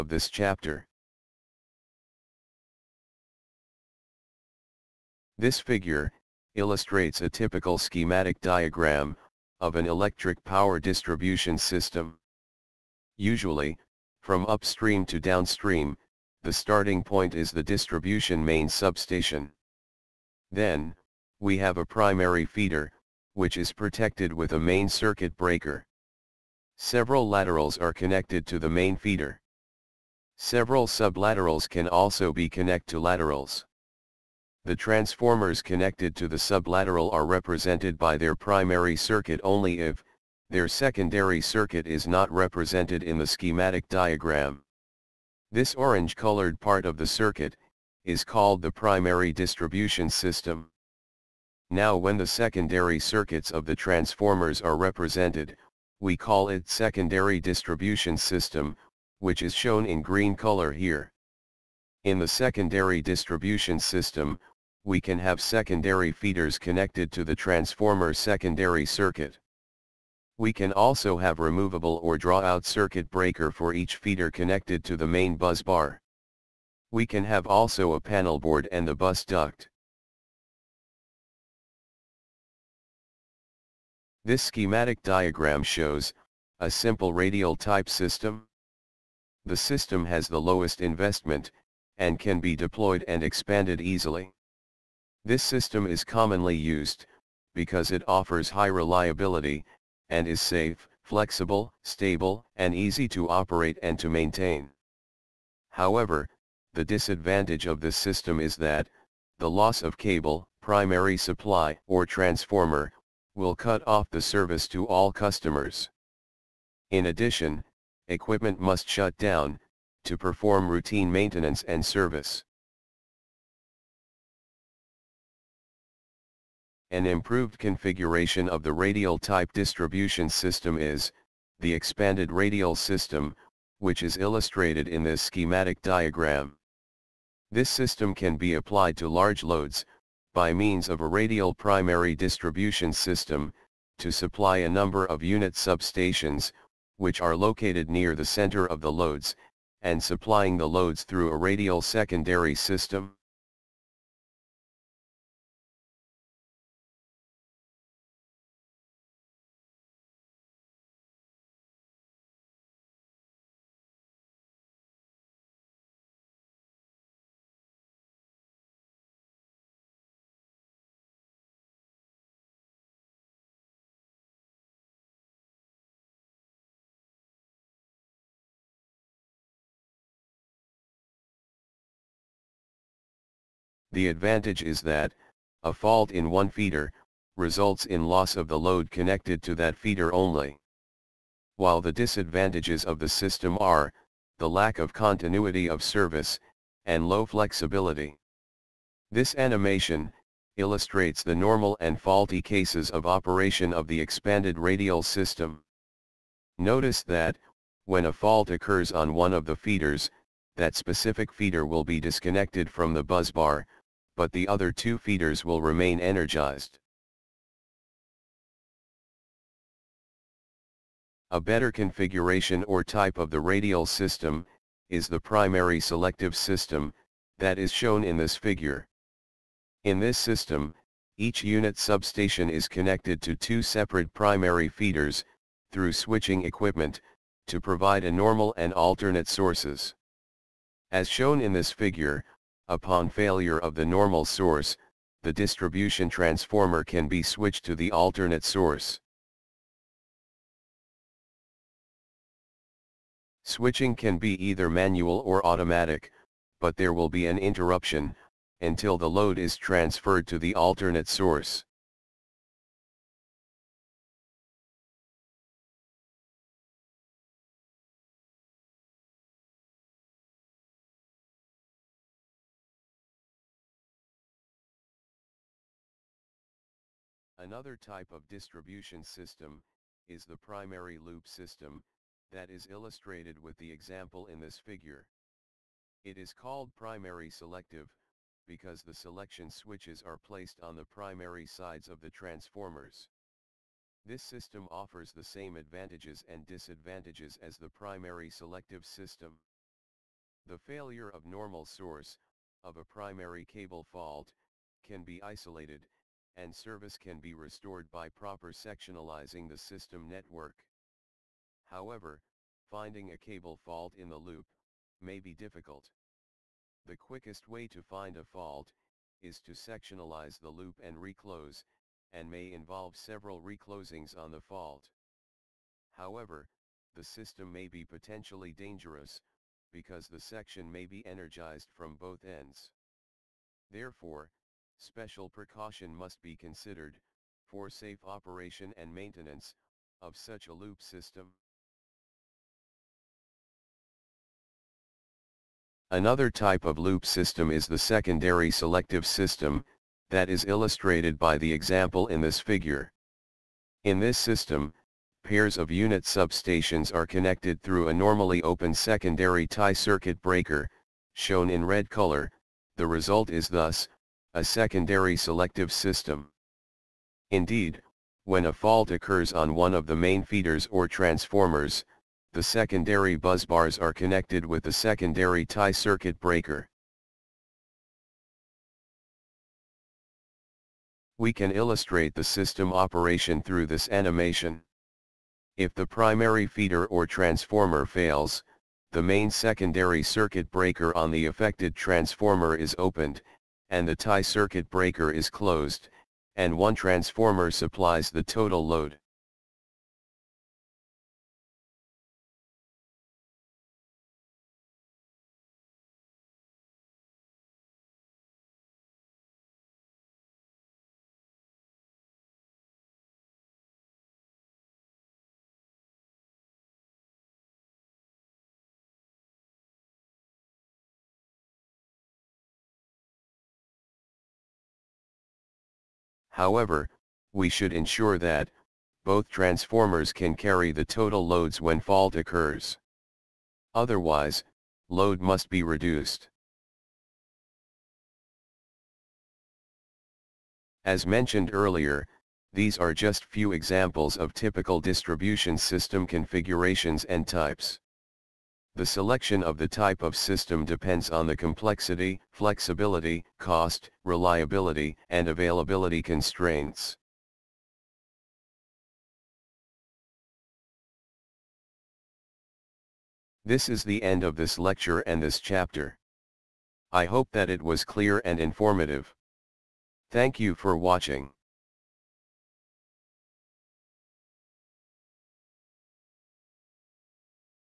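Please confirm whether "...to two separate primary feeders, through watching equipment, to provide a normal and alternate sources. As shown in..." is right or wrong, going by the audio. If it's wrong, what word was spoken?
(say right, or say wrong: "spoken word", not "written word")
wrong: "switching", not "watching".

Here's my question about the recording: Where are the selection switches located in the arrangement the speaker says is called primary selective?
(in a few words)
primary sides of the transformers.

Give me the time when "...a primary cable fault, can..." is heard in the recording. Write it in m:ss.
5:02.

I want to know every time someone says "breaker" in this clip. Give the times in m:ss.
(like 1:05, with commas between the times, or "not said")
0:25, 1:13, 6:00, 6:16, 6:30, 6:34.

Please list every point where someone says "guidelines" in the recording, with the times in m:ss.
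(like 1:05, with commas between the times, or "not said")
not said.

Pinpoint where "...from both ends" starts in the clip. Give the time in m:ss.
5:31.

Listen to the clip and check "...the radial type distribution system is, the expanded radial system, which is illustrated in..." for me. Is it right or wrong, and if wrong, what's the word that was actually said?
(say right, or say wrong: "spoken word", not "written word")
right.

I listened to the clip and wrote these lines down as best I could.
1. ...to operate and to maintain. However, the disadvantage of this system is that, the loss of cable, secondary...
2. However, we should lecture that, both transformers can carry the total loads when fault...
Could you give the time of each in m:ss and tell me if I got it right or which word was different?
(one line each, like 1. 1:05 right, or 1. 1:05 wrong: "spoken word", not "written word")
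1. 1:43 wrong: "primary", not "secondary"
2. 7:06 wrong: "ensure", not "lecture".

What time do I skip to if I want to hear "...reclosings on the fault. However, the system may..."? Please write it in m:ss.
5:23.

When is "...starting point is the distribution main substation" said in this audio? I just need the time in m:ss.
0:16.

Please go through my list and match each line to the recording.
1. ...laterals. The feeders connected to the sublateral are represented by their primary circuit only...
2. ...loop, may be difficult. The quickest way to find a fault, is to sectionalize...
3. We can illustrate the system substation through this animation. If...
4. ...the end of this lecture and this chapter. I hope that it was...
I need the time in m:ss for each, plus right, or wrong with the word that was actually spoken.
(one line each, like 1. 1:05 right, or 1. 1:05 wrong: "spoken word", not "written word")
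1. 0:32 wrong: "transformers", not "feeders"
2. 5:14 right
3. 6:21 wrong: "operation", not "substation"
4. 7:43 right.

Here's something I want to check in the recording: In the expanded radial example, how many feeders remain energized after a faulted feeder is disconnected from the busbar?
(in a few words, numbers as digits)
2.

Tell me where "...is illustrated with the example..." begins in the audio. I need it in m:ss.
4:42.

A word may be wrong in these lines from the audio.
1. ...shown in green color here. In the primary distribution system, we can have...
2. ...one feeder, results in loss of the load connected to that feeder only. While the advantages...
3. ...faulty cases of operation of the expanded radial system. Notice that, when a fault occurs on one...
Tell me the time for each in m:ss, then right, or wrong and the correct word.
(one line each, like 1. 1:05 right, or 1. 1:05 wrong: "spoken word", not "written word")
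1. 0:59 wrong: "secondary", not "primary"
2. 3:06 wrong: "disadvantages", not "advantages"
3. 3:22 right.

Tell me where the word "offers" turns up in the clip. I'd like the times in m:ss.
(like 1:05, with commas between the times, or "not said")
1:38, 4:54.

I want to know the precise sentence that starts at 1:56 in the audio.
In addition, equipment must shut down, to perform routine maintenance and service.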